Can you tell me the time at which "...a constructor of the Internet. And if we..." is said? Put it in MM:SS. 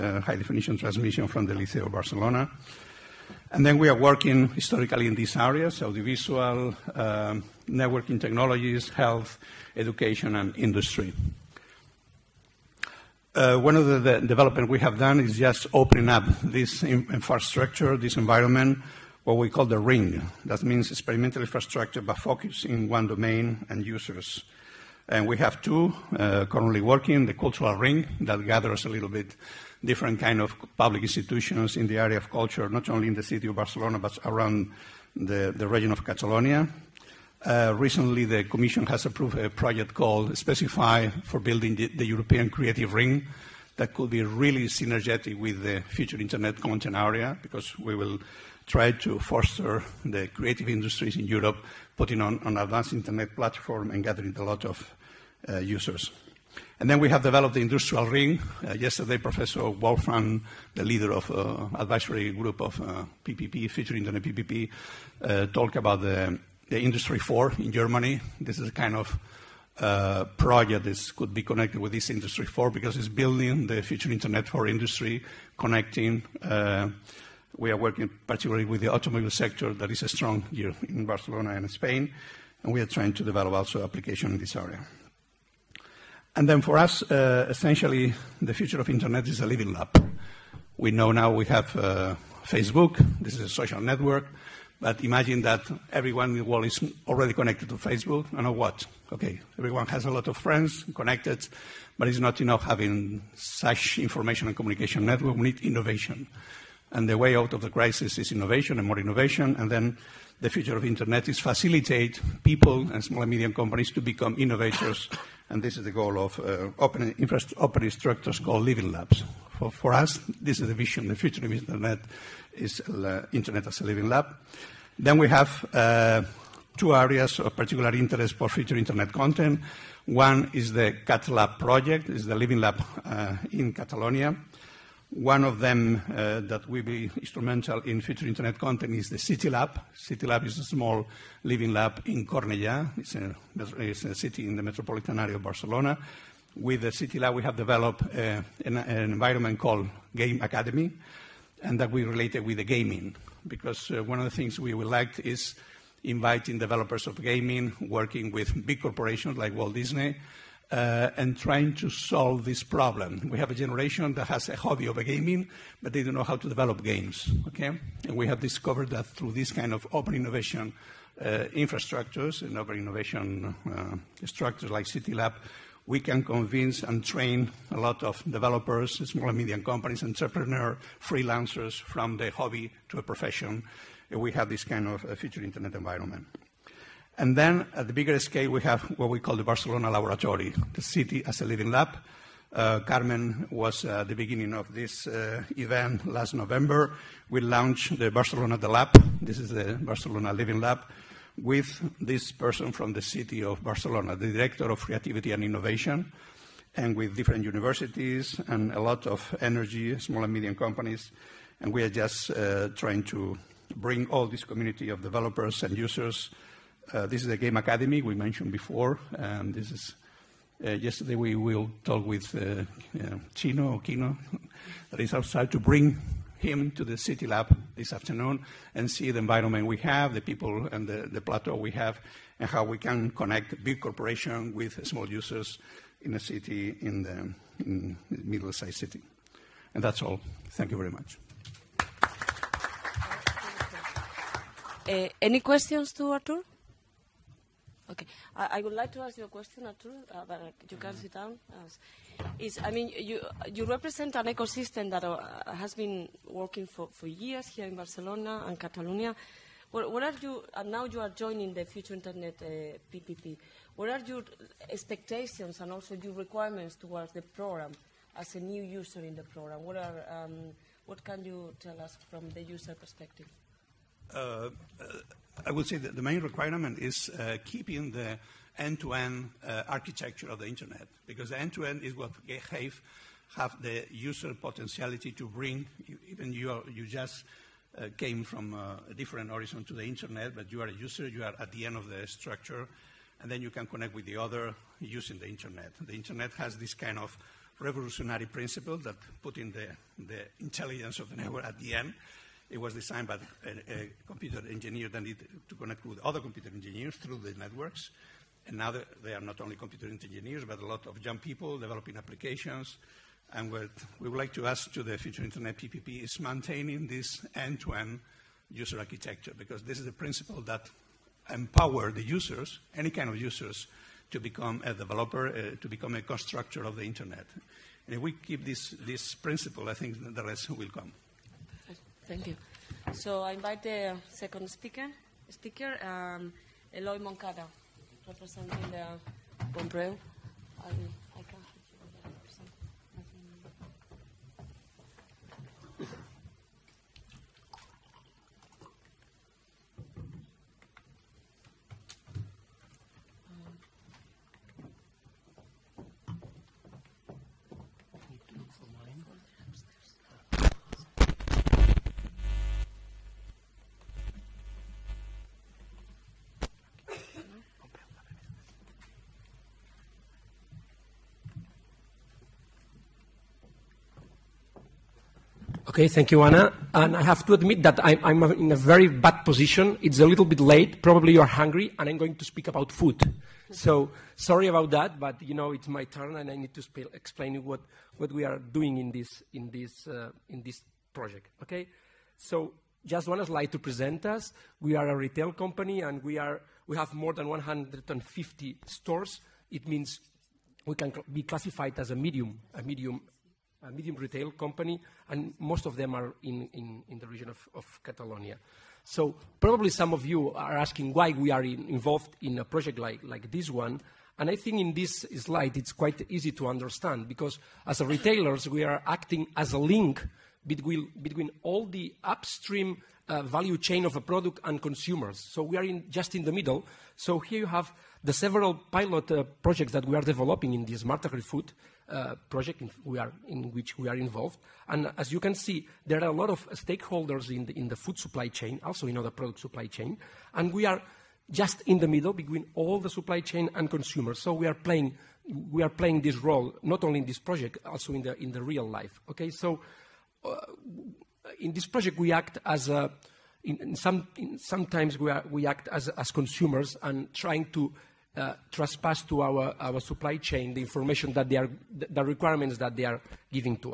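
05:25.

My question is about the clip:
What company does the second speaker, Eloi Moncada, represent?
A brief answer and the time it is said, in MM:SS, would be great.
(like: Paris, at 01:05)
Bon Preu, at 05:39.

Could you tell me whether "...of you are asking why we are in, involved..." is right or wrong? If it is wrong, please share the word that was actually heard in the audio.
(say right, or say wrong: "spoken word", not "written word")
right.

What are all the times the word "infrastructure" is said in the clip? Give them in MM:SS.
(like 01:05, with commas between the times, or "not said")
00:16, 00:21, 02:51.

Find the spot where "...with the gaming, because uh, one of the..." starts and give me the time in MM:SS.
02:32.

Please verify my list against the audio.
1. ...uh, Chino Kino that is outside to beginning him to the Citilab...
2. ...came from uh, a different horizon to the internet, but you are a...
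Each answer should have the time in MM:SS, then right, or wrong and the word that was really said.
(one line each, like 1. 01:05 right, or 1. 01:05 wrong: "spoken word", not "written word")
1. 03:43 wrong: "bring", not "beginning"
2. 04:47 right.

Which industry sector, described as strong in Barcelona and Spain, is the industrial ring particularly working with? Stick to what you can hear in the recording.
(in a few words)
automobile sector.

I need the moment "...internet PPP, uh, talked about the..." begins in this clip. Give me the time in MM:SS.
01:03.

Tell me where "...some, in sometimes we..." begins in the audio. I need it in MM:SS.
07:33.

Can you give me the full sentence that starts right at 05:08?
And now they are not only computer engineers, but a lot of young people developing applications.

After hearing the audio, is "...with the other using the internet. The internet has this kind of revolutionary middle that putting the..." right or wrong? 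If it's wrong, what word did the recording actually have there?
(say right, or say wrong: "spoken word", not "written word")
wrong: "principle", not "middle".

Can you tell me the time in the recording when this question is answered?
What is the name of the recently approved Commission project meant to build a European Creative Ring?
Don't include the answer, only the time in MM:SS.
00:40.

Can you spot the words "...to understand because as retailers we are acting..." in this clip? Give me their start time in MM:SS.
06:56.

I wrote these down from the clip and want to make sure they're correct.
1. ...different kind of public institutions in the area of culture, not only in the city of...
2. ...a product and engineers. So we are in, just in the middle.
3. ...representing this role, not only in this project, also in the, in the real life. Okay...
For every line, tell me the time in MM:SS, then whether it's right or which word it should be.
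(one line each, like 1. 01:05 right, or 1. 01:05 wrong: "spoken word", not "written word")
1. 00:29 right
2. 07:03 wrong: "consumers", not "engineers"
3. 07:25 wrong: "playing", not "representing".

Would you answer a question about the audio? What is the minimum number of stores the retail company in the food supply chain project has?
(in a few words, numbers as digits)
150.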